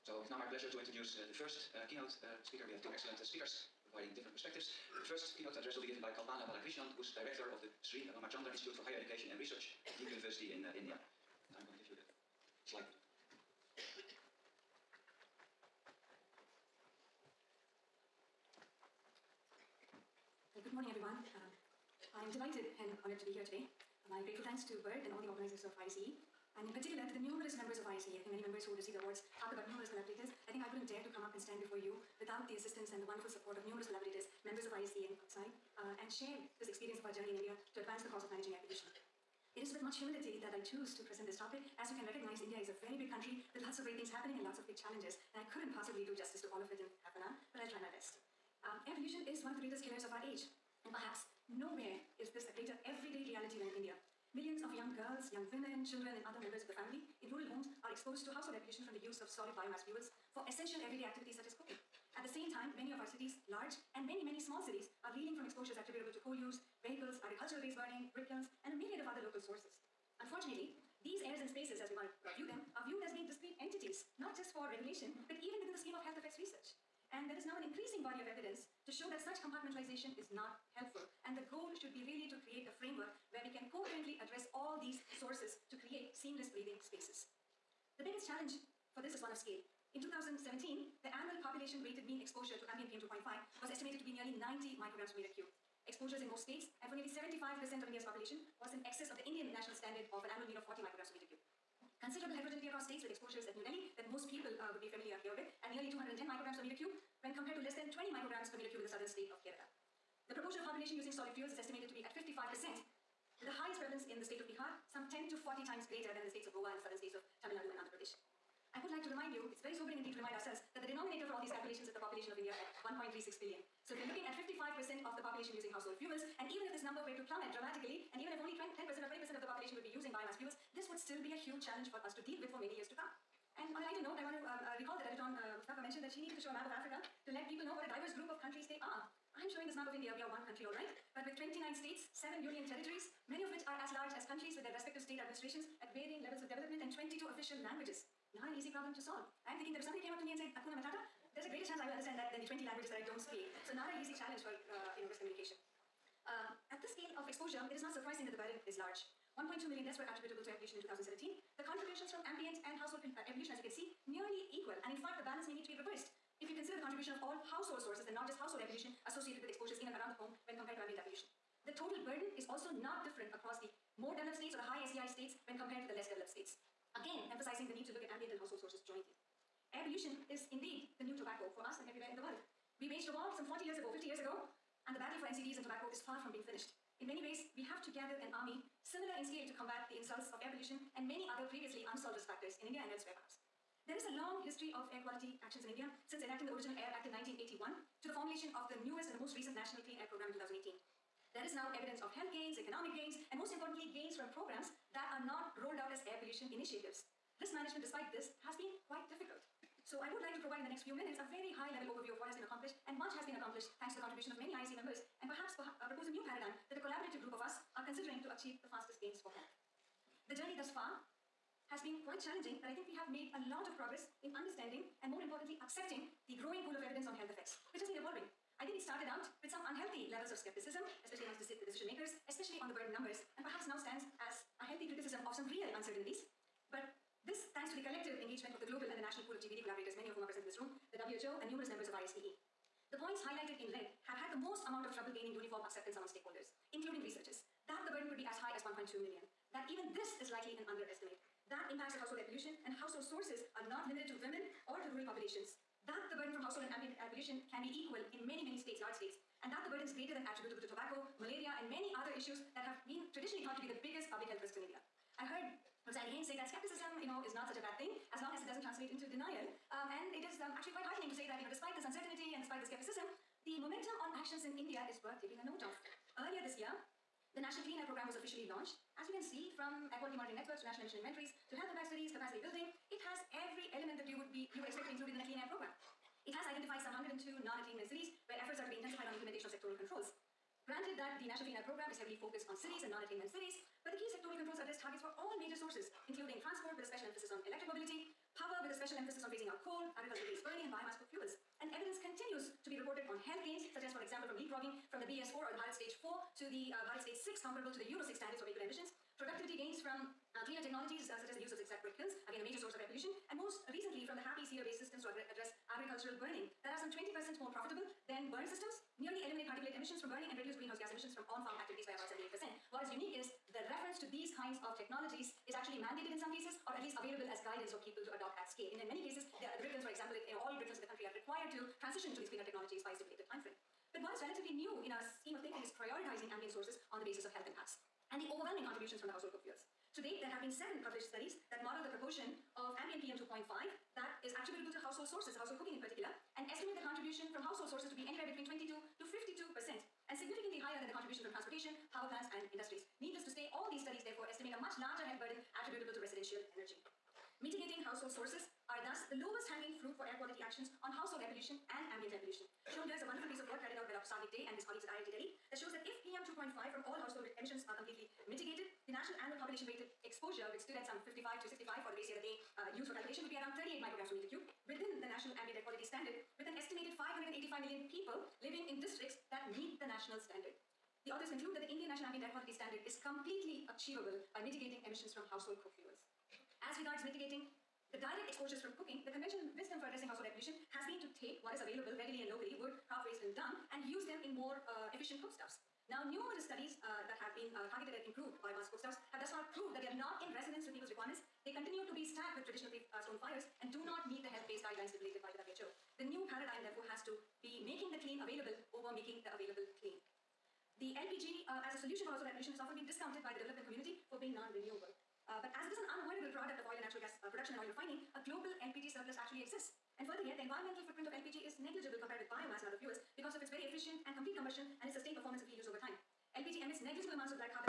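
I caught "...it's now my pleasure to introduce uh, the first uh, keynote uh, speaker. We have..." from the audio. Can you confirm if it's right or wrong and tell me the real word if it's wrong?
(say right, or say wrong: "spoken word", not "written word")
right.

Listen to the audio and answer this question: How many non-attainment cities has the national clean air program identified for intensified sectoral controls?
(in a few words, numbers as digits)
102.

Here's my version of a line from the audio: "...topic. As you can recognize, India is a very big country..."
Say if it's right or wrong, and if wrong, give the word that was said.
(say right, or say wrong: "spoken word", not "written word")
right.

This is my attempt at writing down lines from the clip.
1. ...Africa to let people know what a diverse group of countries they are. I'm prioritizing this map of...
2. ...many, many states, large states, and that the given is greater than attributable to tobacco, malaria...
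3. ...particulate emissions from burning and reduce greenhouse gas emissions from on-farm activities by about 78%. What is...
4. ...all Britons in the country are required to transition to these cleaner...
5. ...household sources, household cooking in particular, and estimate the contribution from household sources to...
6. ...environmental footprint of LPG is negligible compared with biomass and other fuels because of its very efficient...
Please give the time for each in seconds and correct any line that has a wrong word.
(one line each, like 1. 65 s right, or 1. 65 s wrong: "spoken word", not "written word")
1. 136 s wrong: "showing", not "prioritizing"
2. 258 s wrong: "burden", not "given"
3. 319 s right
4. 330 s right
5. 344 s right
6. 420 s right.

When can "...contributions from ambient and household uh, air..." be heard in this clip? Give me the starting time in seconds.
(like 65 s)
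161 s.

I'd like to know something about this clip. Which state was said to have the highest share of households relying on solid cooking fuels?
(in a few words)
Bihar.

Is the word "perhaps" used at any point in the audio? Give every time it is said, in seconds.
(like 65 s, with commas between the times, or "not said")
50 s, 193 s, 215 s, 233 s.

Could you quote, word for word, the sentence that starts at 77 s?
And there is now an increasing body of evidence to show that such compartmentalization is not helpful.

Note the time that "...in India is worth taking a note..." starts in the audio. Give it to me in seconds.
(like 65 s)
274 s.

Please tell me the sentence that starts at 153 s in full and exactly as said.
So not an easy challenge for uh, you know, risk communication.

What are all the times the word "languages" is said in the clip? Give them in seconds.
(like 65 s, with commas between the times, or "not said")
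147 s, 152 s.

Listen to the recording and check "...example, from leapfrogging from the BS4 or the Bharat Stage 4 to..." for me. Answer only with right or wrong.
right.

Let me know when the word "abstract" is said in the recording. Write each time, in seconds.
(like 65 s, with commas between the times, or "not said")
not said.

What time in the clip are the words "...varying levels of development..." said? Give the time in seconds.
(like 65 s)
145 s.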